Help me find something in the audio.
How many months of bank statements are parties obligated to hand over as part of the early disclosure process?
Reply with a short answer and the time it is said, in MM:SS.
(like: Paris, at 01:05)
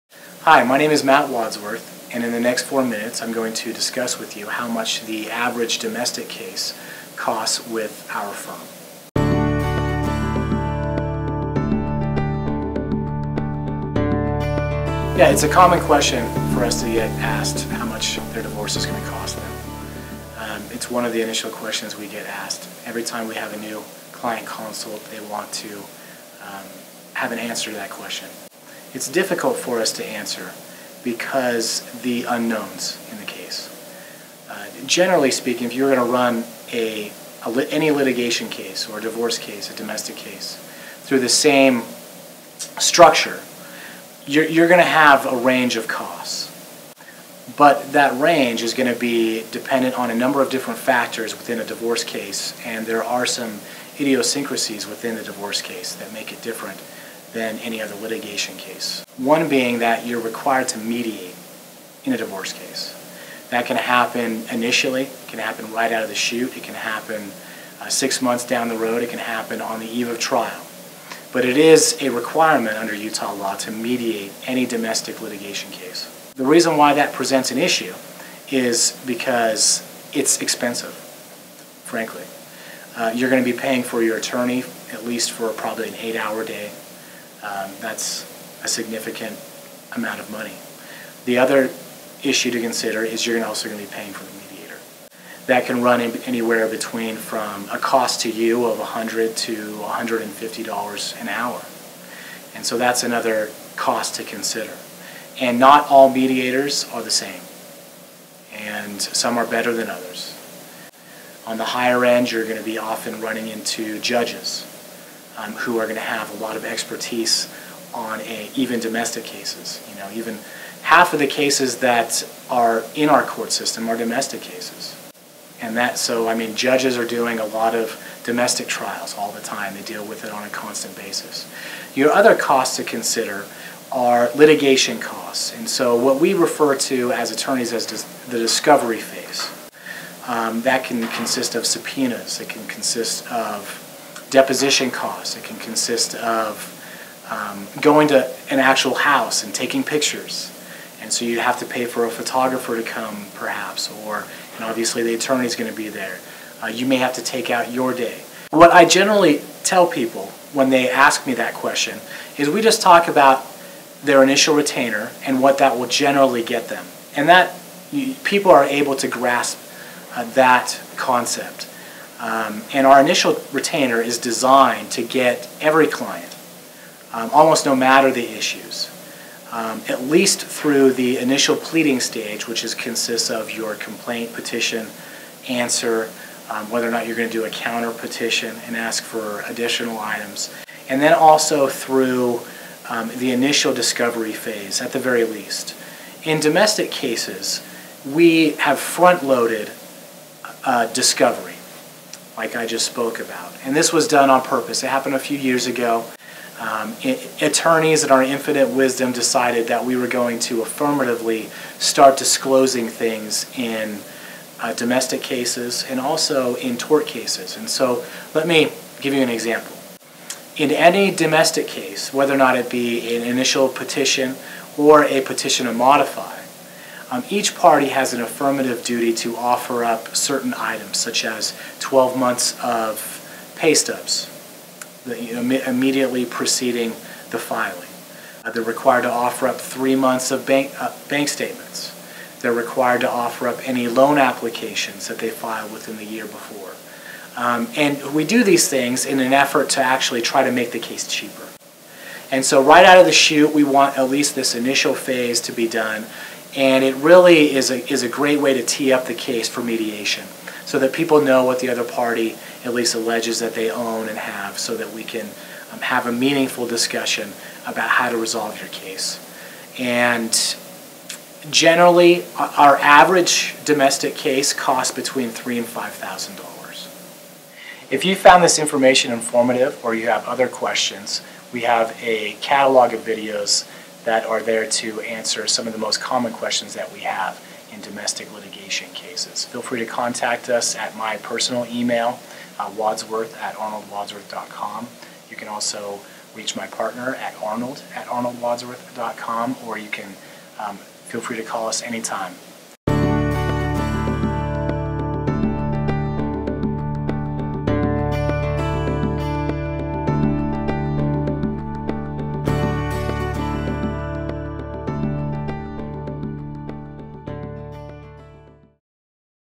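3, at 03:59.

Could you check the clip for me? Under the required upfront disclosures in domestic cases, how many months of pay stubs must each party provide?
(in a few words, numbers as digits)
12.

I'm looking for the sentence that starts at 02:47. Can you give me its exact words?
And that you, people are able to grasp uh, that concept.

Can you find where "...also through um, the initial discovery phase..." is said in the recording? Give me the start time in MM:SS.
03:11.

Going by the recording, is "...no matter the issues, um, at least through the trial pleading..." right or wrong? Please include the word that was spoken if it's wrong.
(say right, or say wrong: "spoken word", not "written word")
wrong: "initial", not "trial".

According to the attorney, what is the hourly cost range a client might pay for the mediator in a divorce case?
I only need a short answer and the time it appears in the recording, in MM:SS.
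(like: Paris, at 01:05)
$100 to $150 an hour, at 01:38.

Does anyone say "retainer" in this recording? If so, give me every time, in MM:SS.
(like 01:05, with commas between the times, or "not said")
02:44, 02:53.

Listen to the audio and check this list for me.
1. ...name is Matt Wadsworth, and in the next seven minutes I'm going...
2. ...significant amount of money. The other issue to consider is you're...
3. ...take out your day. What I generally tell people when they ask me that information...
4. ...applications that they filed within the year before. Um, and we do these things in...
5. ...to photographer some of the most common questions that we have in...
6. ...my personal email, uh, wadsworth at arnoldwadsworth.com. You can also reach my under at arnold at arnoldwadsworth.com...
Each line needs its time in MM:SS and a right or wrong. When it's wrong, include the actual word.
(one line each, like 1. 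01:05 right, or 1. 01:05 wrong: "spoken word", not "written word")
1. 00:00 wrong: "four", not "seven"
2. 01:28 right
3. 02:37 wrong: "question", not "information"
4. 04:04 right
5. 04:44 wrong: "answer", not "photographer"
6. 04:50 wrong: "partner", not "under".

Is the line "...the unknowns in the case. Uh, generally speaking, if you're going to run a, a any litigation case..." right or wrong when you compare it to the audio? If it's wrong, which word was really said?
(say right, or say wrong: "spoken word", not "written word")
right.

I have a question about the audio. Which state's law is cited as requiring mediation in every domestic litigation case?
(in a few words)
Utah.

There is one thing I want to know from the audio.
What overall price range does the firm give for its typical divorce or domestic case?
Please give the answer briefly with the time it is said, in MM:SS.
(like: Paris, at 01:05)
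$3,000 to $5,000, at 04:35.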